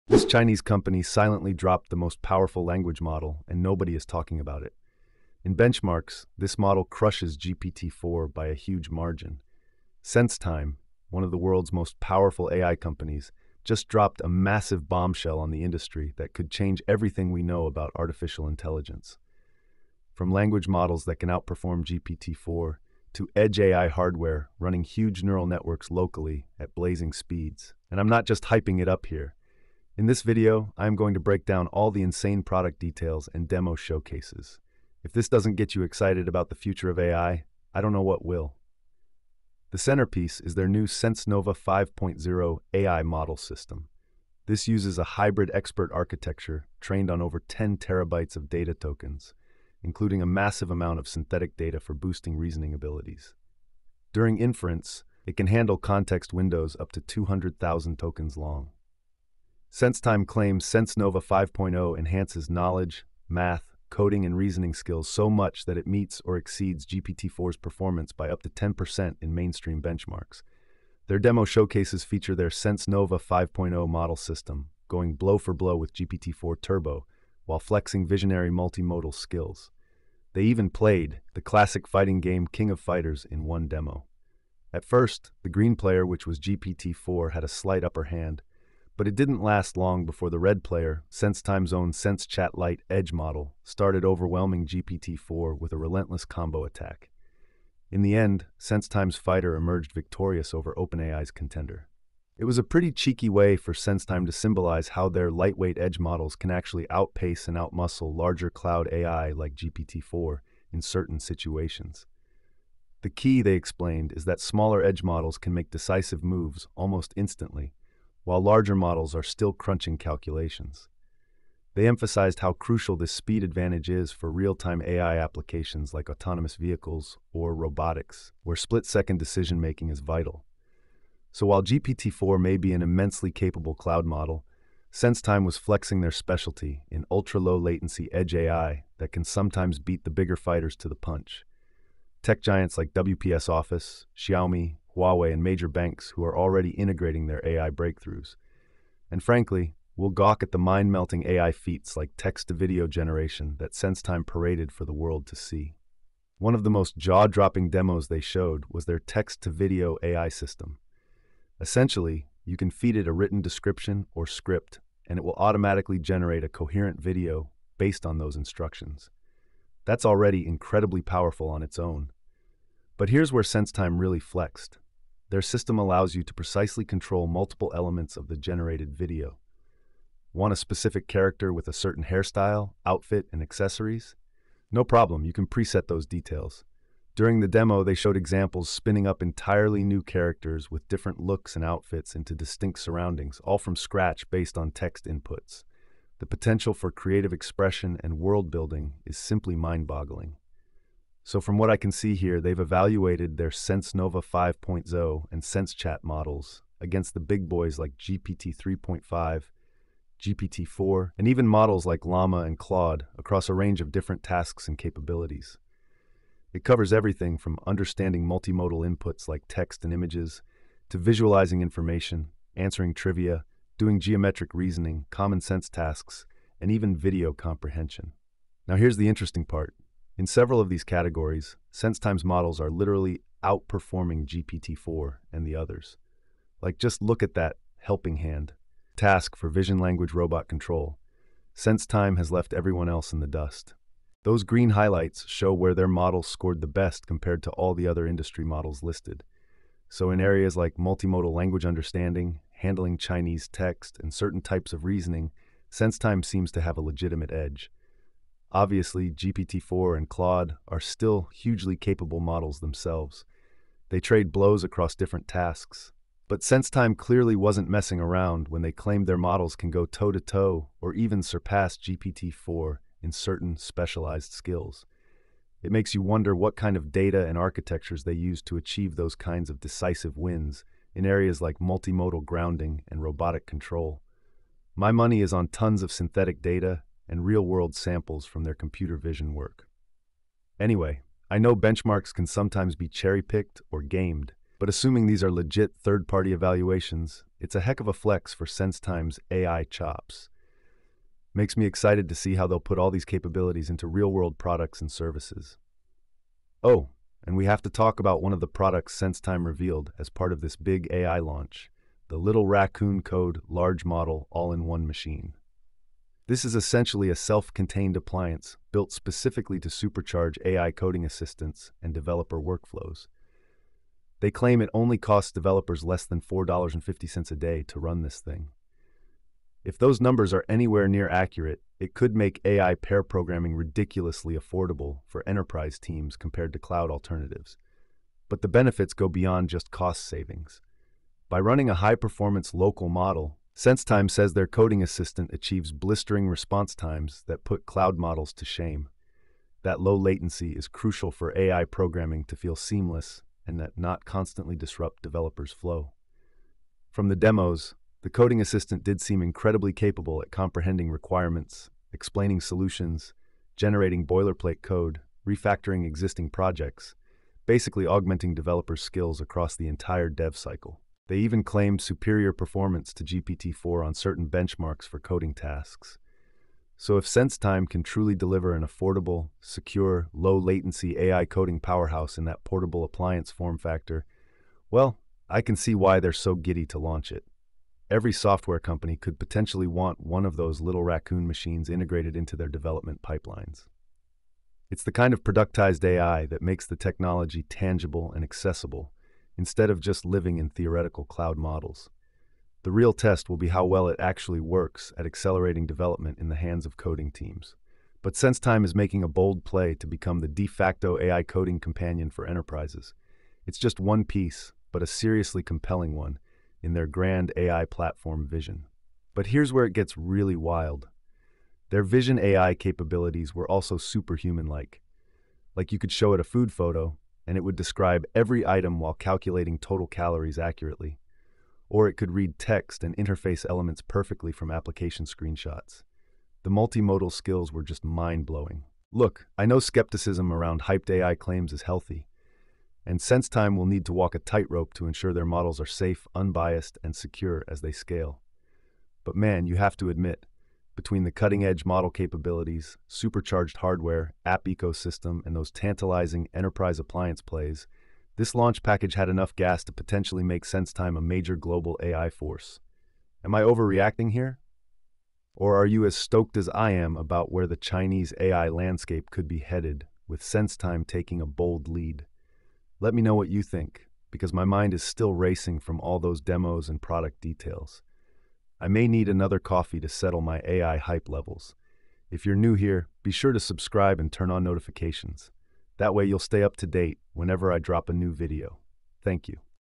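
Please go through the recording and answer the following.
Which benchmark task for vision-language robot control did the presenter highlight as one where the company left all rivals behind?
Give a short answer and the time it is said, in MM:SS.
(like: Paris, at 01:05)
helping hand, at 03:57.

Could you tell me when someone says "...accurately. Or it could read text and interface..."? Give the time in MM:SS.
07:10.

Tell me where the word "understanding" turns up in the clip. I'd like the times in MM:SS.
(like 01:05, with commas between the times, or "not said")
03:37, 04:11.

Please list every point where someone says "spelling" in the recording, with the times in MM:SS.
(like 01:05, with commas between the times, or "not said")
not said.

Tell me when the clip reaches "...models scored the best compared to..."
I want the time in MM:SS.
04:05.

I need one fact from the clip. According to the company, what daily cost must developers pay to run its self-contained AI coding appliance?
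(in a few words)
less than $4.50.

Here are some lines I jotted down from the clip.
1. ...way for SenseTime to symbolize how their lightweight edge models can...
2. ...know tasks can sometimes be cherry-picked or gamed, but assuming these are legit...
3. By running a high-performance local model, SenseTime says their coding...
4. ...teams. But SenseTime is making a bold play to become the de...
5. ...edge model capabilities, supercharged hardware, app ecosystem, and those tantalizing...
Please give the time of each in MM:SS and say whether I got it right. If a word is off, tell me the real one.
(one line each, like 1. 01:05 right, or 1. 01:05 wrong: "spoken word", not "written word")
1. 01:43 right
2. 04:51 wrong: "benchmarks", not "tasks"
3. 05:41 right
4. 06:47 right
5. 07:31 right.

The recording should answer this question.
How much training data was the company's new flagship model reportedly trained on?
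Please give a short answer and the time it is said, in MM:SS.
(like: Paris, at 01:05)
over 10 terabytes, at 00:47.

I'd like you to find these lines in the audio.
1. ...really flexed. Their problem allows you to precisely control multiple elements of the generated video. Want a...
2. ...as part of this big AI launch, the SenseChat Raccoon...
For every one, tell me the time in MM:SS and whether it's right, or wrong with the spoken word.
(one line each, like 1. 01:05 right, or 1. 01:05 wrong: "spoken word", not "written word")
1. 02:53 wrong: "system", not "problem"
2. 05:09 wrong: "Little", not "SenseChat".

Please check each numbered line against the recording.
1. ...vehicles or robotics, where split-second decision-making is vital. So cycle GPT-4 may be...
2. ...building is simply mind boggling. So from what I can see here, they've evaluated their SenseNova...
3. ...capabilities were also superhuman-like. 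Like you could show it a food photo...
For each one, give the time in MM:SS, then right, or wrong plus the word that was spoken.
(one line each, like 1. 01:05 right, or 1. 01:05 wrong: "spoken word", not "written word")
1. 02:06 wrong: "while", not "cycle"
2. 03:18 right
3. 07:02 right.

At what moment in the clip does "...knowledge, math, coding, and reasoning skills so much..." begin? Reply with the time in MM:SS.
01:02.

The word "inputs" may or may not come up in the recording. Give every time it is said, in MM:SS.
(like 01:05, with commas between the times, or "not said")
03:15, 03:38.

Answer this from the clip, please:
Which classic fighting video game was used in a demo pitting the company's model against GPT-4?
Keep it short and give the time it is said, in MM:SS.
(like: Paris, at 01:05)
King of Fighters, at 01:22.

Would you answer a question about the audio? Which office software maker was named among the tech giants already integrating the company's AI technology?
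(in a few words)
WPS Office.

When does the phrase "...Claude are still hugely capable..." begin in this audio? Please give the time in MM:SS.
04:20.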